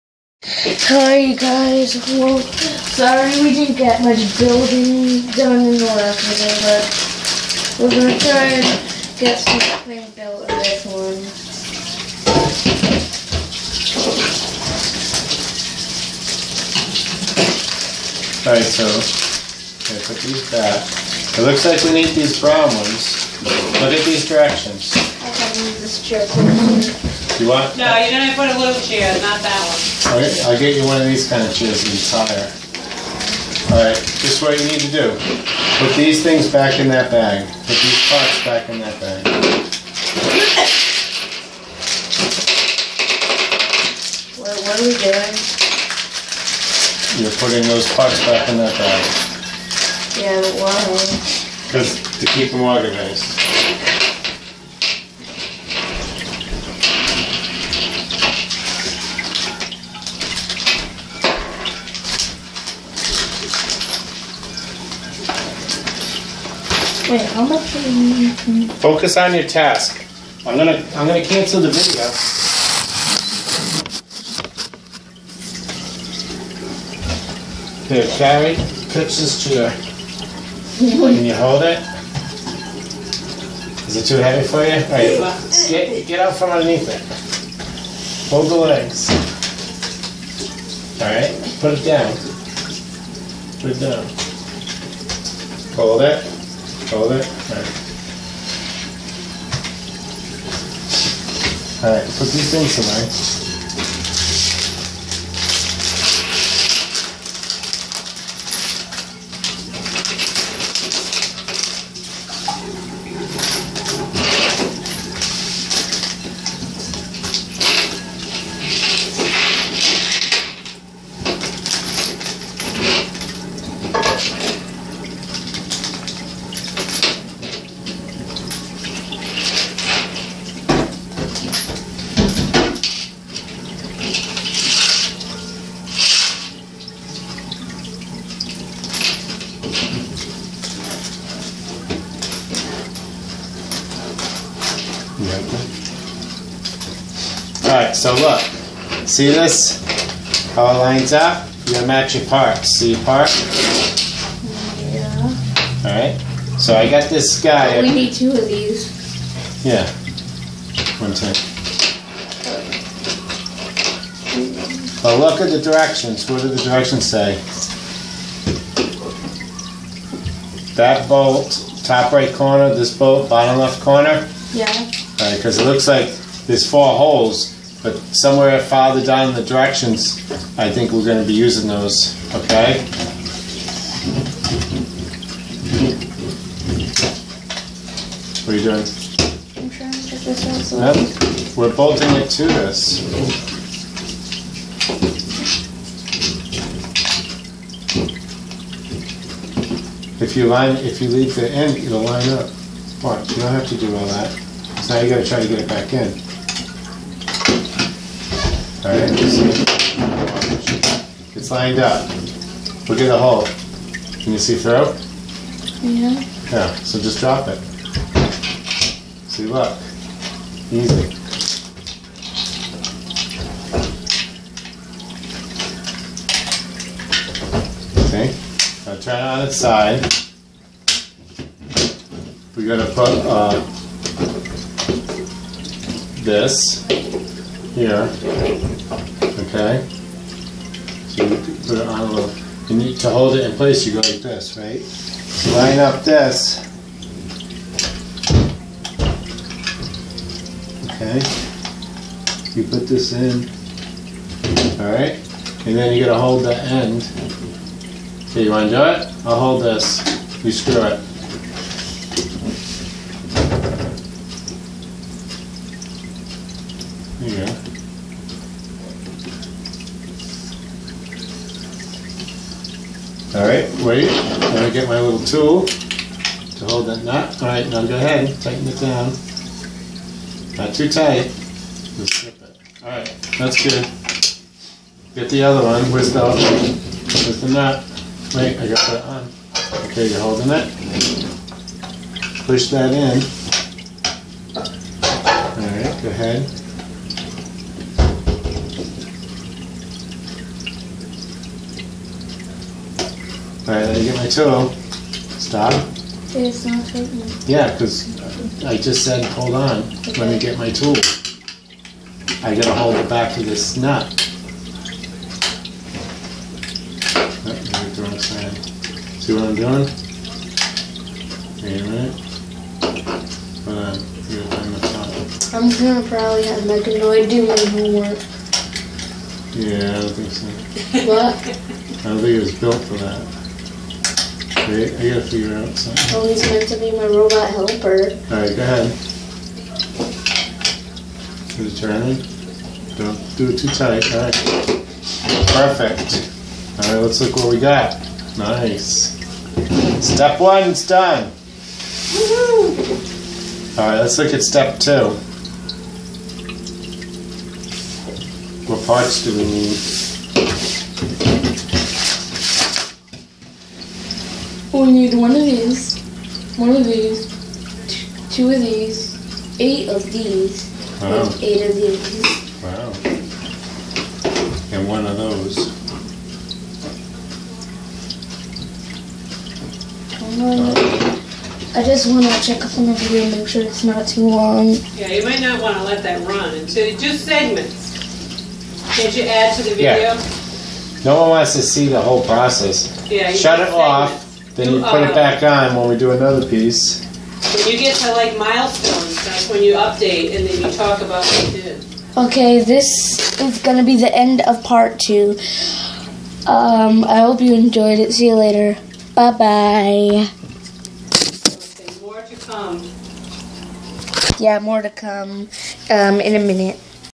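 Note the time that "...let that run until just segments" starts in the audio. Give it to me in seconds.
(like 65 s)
385 s.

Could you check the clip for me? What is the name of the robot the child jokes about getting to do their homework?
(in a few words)
Meccanoid.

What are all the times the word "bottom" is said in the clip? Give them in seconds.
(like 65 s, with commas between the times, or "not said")
173 s.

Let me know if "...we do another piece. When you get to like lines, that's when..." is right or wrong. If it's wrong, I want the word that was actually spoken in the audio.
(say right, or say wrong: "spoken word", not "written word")
wrong: "milestones", not "lines".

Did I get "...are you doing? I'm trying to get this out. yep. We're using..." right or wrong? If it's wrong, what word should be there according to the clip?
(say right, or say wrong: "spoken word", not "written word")
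wrong: "bolting", not "using".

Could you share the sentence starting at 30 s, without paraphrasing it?
Okay, I'll get you one of these kind of chairs and it's higher.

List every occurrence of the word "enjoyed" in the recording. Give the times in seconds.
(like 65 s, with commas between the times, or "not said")
407 s.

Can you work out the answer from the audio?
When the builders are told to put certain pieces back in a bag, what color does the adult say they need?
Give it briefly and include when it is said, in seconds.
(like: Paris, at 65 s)
Brown, at 22 s.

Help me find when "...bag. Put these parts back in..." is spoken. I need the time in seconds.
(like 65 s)
37 s.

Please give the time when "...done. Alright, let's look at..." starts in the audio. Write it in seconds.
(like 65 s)
350 s.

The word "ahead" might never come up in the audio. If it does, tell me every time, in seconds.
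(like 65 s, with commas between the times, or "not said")
277 s, 296 s, 338 s.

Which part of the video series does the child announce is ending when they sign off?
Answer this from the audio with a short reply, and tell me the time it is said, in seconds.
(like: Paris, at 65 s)
Part two, at 404 s.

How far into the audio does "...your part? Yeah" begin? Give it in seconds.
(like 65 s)
152 s.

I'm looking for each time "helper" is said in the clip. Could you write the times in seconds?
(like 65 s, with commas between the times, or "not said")
337 s.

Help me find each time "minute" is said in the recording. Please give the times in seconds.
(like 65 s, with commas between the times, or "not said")
321 s, 416 s.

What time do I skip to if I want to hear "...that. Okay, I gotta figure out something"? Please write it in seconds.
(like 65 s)
332 s.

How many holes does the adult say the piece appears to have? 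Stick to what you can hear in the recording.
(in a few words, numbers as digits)
4.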